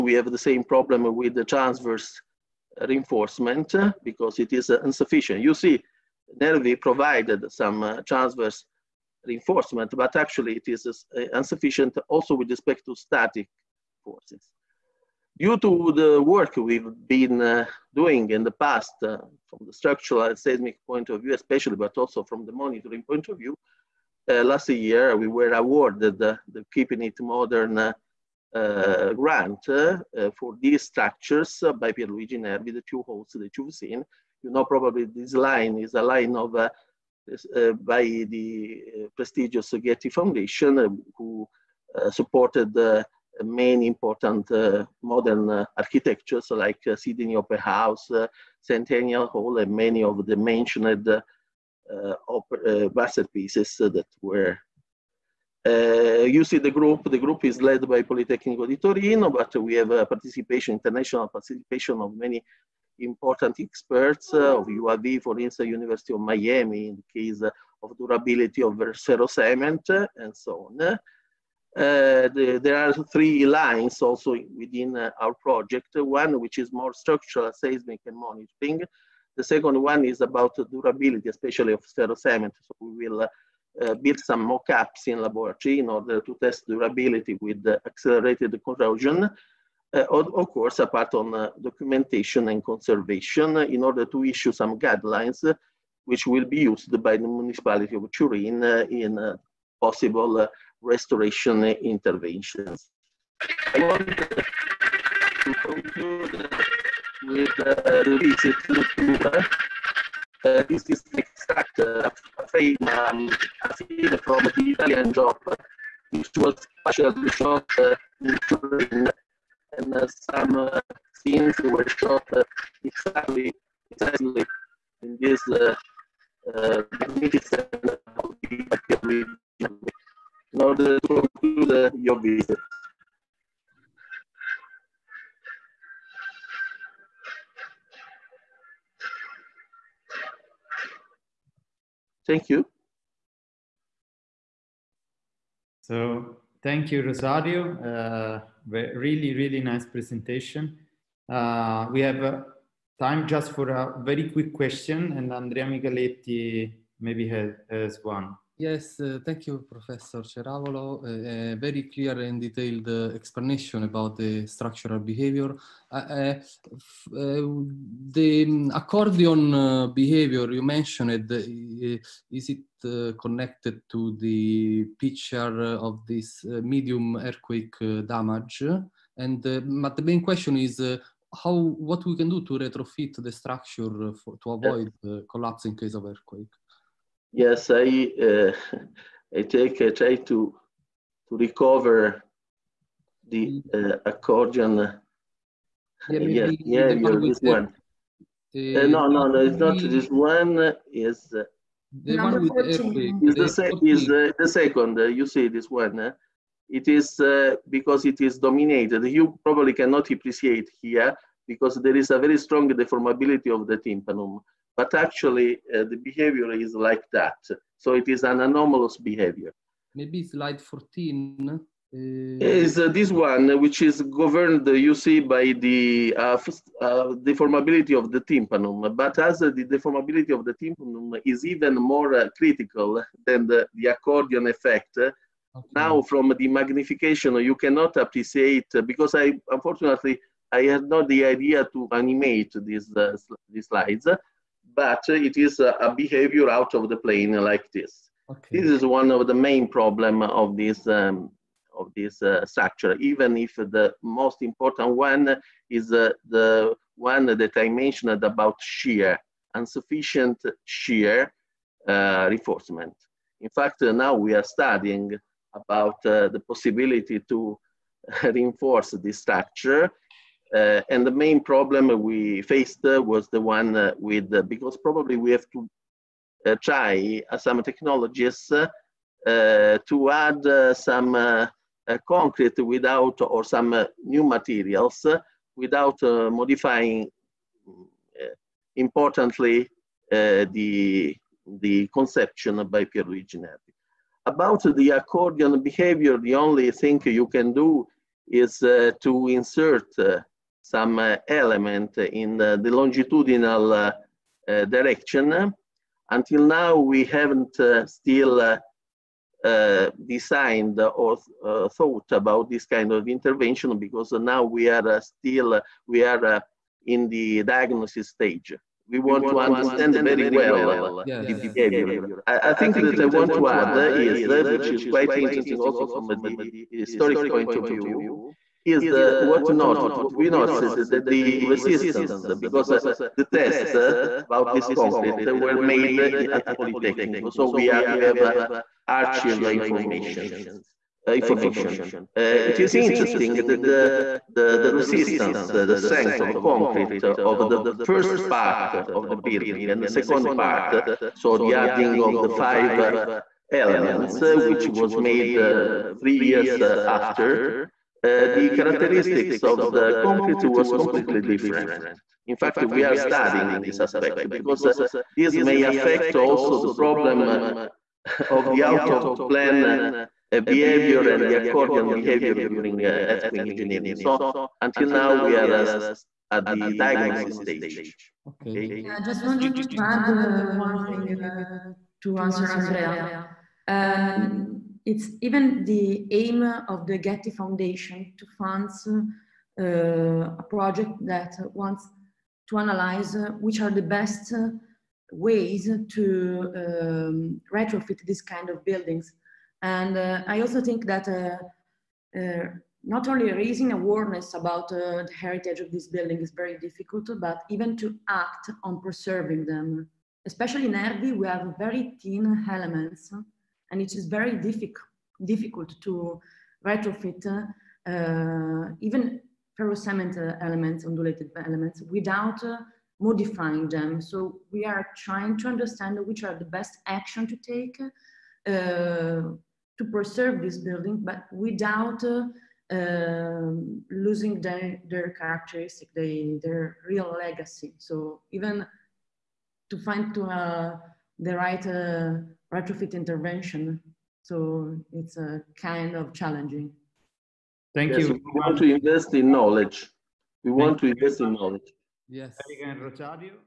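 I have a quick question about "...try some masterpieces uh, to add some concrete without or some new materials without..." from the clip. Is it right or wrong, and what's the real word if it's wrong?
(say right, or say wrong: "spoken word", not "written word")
wrong: "technologies", not "masterpieces".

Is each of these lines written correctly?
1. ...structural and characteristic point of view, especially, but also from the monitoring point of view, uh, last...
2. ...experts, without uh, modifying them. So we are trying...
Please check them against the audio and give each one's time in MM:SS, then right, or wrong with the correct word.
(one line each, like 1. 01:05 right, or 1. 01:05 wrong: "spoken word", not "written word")
1. 00:19 wrong: "seismic", not "characteristic"
2. 07:01 wrong: "elements", not "experts".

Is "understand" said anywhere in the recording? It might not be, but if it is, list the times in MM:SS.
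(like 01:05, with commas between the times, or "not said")
05:19, 07:05.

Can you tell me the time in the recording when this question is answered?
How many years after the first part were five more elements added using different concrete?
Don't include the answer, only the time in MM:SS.
05:56.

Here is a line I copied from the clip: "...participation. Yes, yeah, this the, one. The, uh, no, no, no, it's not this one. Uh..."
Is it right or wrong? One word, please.
wrong.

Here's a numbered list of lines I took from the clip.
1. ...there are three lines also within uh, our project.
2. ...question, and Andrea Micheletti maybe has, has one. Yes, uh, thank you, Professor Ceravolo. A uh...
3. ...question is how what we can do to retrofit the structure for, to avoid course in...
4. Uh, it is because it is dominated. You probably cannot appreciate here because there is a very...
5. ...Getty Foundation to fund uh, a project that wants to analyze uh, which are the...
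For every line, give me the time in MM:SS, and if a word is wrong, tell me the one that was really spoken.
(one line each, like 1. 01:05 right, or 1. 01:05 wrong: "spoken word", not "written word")
1. 01:12 right
2. 02:34 right
3. 03:00 wrong: "collapse", not "course"
4. 03:25 right
5. 06:26 right.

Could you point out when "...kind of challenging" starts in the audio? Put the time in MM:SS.
07:25.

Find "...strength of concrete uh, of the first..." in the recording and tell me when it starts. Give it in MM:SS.
05:45.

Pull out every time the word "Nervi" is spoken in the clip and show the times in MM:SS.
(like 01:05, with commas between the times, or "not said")
00:06, 00:32, 04:53.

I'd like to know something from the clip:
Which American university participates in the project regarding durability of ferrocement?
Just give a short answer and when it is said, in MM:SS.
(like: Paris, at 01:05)
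University of Miami, at 01:05.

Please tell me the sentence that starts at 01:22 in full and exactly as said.
So we will uh, uh, build some mock-ups in laboratory in order to test durability with accelerated corrosion.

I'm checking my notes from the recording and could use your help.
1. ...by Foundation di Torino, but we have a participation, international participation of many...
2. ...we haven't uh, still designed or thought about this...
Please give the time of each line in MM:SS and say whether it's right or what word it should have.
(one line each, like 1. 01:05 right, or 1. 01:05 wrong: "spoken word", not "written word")
1. 00:57 wrong: "Politecnico", not "Foundation"
2. 05:06 right.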